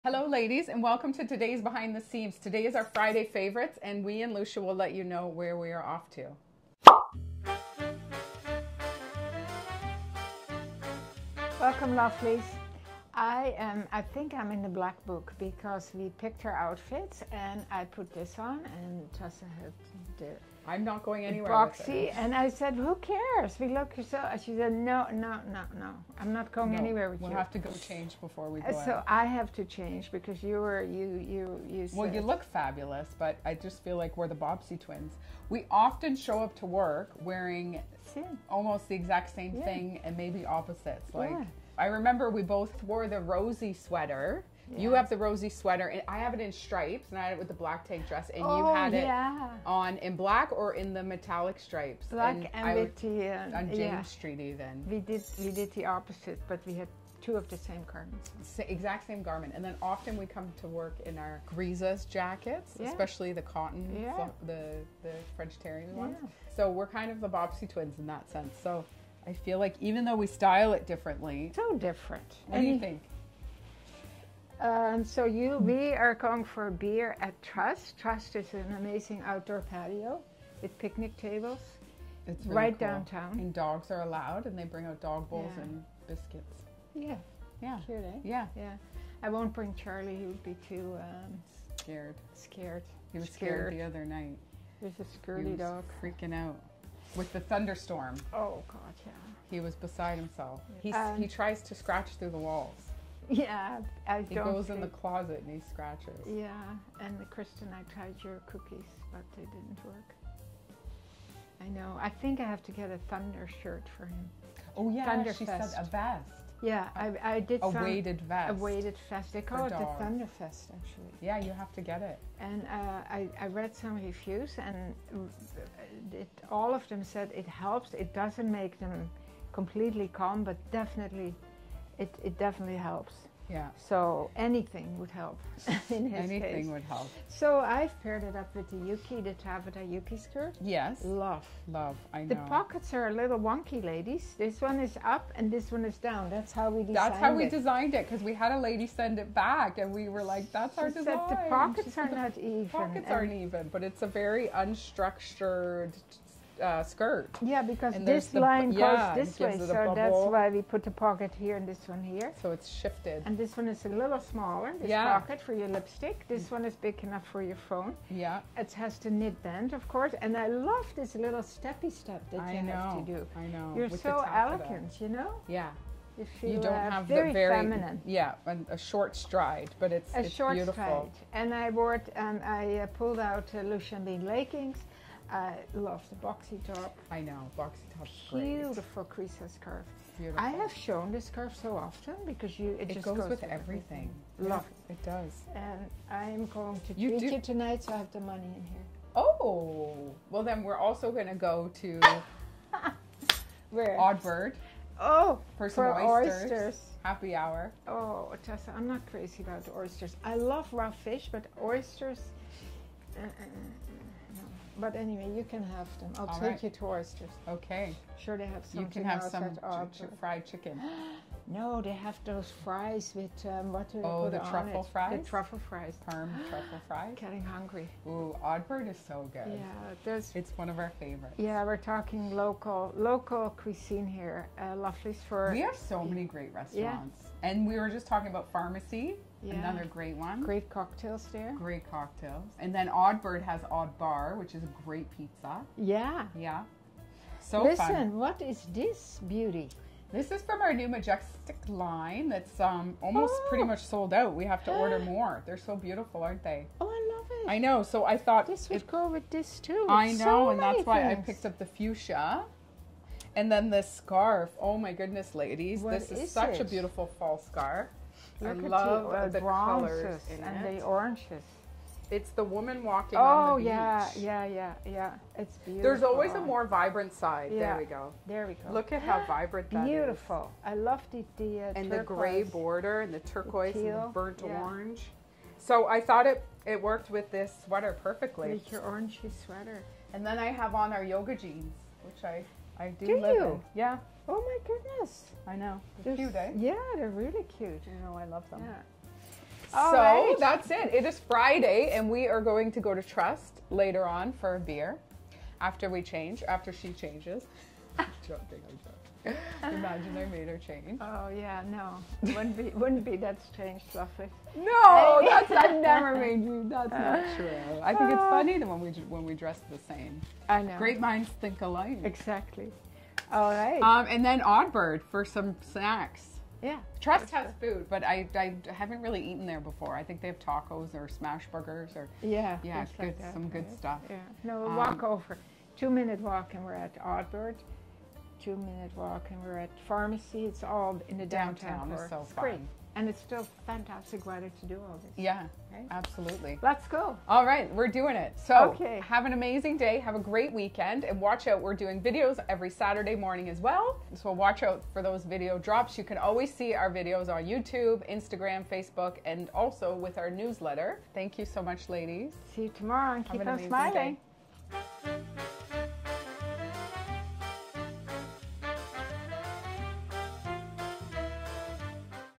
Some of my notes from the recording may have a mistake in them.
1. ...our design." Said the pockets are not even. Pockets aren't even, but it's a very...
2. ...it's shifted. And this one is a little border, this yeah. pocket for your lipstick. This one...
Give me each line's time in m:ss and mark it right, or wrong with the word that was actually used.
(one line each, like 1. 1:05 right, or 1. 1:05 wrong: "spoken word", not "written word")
1. 2:30 right
2. 2:42 wrong: "smaller", not "border".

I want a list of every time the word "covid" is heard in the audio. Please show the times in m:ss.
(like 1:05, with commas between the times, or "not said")
not said.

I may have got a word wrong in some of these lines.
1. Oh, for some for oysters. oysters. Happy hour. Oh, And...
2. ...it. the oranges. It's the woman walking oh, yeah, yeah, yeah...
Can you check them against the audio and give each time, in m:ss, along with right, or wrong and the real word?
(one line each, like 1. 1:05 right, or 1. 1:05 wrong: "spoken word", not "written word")
1. 3:24 wrong: "Tessa", not "And"
2. 4:30 right.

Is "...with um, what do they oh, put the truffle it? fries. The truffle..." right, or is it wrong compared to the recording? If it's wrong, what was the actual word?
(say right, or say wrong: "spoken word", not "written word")
right.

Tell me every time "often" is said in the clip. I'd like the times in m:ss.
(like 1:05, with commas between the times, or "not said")
0:35, 0:59, 3:11.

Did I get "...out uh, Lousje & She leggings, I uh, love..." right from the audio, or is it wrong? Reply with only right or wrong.
wrong.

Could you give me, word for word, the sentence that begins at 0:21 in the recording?
Roxy and I said, "Who cares?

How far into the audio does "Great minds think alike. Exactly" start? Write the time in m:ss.
5:20.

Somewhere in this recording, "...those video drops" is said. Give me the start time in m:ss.
5:55.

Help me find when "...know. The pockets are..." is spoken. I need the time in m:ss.
2:22.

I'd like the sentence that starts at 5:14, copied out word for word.
No, that's I've never made you.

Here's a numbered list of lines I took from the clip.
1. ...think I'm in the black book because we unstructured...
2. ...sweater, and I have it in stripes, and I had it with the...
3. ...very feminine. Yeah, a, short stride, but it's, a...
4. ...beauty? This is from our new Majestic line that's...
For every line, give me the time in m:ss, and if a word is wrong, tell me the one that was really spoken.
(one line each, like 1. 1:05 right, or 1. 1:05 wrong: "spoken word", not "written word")
1. 0:14 wrong: "picked", not "unstructured"
2. 0:45 right
3. 2:57 right
4. 4:09 right.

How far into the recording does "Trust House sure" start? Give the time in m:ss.
5:26.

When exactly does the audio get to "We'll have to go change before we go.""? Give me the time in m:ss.
0:27.